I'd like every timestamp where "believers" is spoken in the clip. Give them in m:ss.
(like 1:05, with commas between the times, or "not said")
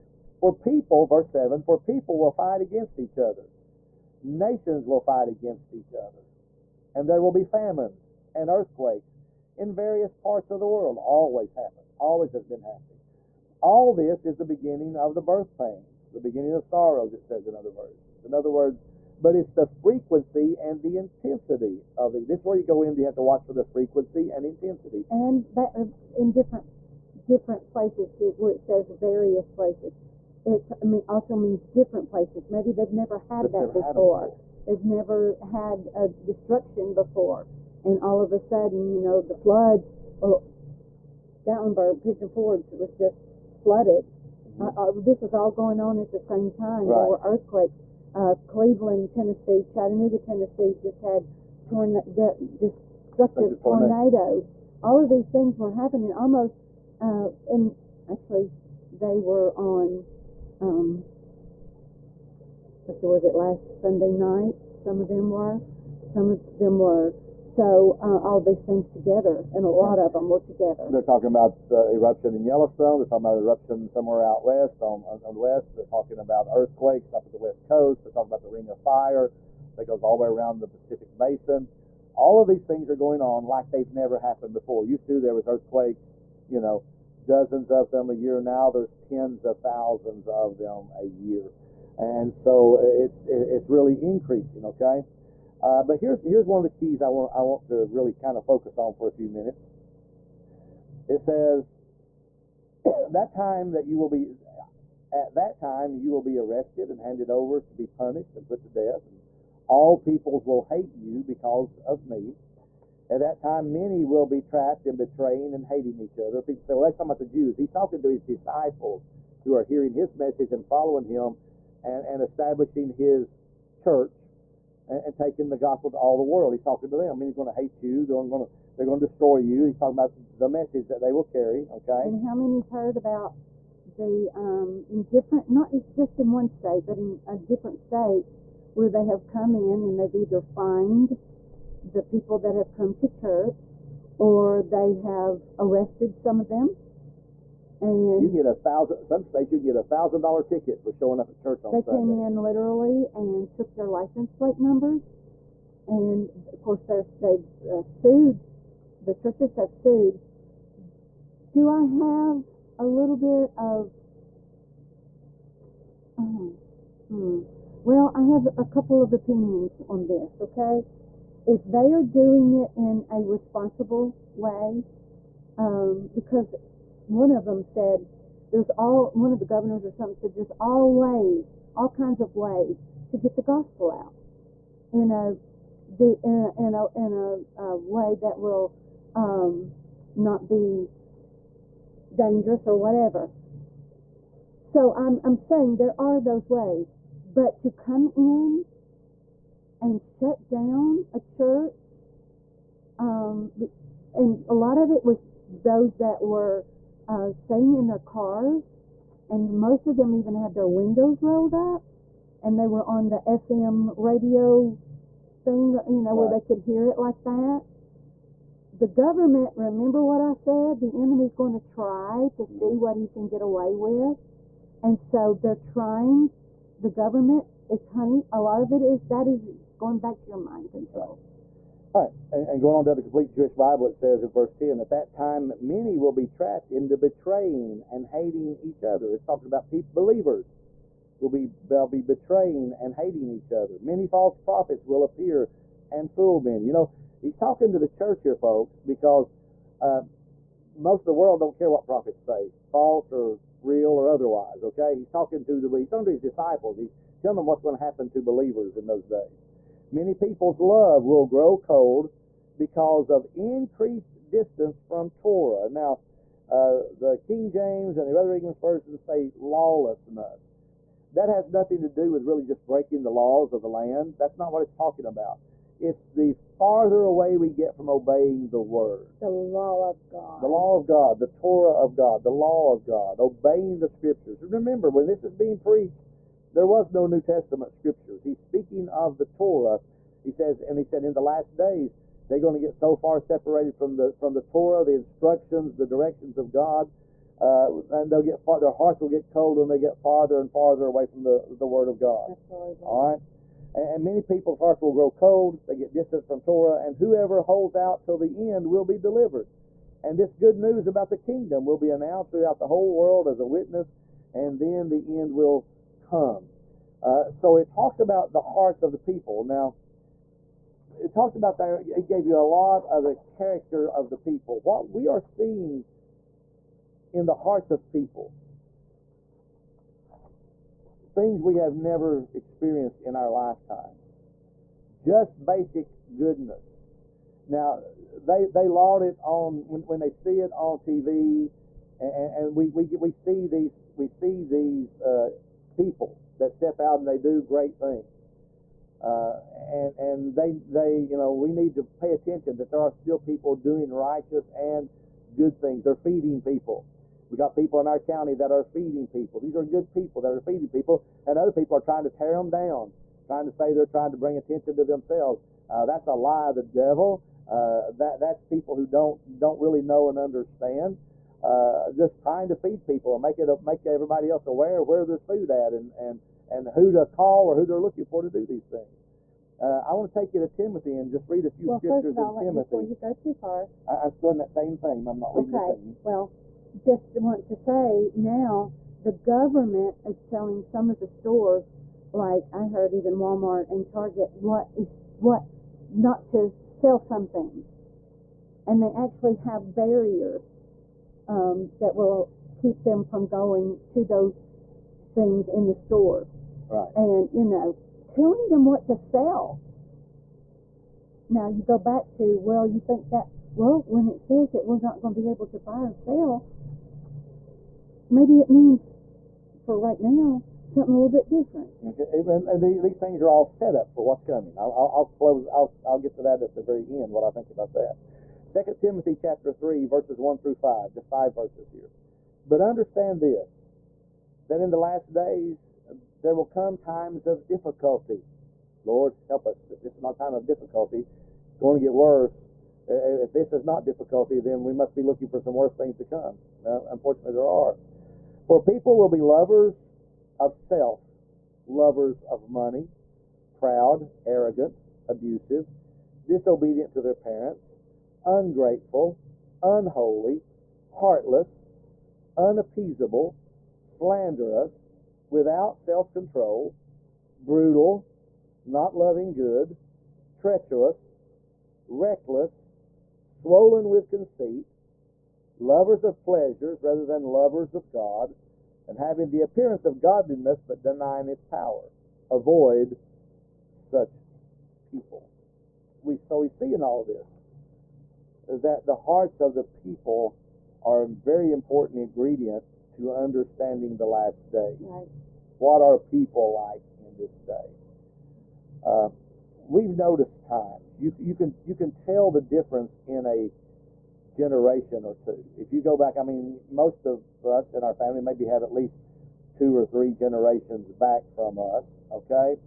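4:00, 4:18.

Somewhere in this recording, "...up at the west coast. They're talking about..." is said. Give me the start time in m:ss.
1:17.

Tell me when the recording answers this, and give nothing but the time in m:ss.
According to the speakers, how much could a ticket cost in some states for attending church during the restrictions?
2:29.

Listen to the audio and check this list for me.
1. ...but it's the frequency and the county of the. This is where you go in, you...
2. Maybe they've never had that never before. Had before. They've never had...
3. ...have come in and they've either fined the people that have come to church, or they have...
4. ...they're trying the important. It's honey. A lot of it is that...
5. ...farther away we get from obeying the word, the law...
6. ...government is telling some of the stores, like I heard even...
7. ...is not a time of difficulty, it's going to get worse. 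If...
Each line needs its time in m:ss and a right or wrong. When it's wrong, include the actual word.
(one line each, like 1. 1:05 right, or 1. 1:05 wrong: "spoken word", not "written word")
1. 0:19 wrong: "intensity", not "county"
2. 0:32 right
3. 2:19 right
4. 3:45 wrong: "government", not "important"
5. 4:36 right
6. 6:29 right
7. 7:19 right.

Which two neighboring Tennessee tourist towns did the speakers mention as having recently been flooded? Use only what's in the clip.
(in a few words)
Gatlinburg, Pigeon Forge.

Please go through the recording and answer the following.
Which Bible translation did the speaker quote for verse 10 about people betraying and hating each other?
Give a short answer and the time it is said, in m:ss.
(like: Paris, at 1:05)
Complete Jewish Bible, at 3:53.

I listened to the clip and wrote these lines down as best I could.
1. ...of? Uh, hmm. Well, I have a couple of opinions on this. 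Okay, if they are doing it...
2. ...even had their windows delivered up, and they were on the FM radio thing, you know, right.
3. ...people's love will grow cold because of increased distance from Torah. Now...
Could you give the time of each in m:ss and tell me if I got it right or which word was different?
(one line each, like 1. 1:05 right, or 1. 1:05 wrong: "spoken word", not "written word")
1. 2:43 right
2. 3:30 wrong: "rolled", not "delivered"
3. 4:20 right.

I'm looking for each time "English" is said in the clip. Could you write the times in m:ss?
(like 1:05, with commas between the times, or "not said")
4:28.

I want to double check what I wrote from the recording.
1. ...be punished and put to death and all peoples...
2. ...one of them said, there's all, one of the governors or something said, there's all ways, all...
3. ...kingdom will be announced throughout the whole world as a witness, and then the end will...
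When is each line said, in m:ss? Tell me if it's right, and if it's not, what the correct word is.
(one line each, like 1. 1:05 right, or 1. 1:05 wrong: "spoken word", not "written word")
1. 1:47 right
2. 2:57 right
3. 5:11 right.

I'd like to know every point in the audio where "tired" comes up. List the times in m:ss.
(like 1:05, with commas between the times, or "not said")
not said.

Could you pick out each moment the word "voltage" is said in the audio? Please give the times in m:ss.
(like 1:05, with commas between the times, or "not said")
not said.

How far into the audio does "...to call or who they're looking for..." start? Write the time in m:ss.
6:16.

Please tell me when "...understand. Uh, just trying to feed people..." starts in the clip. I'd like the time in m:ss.
6:10.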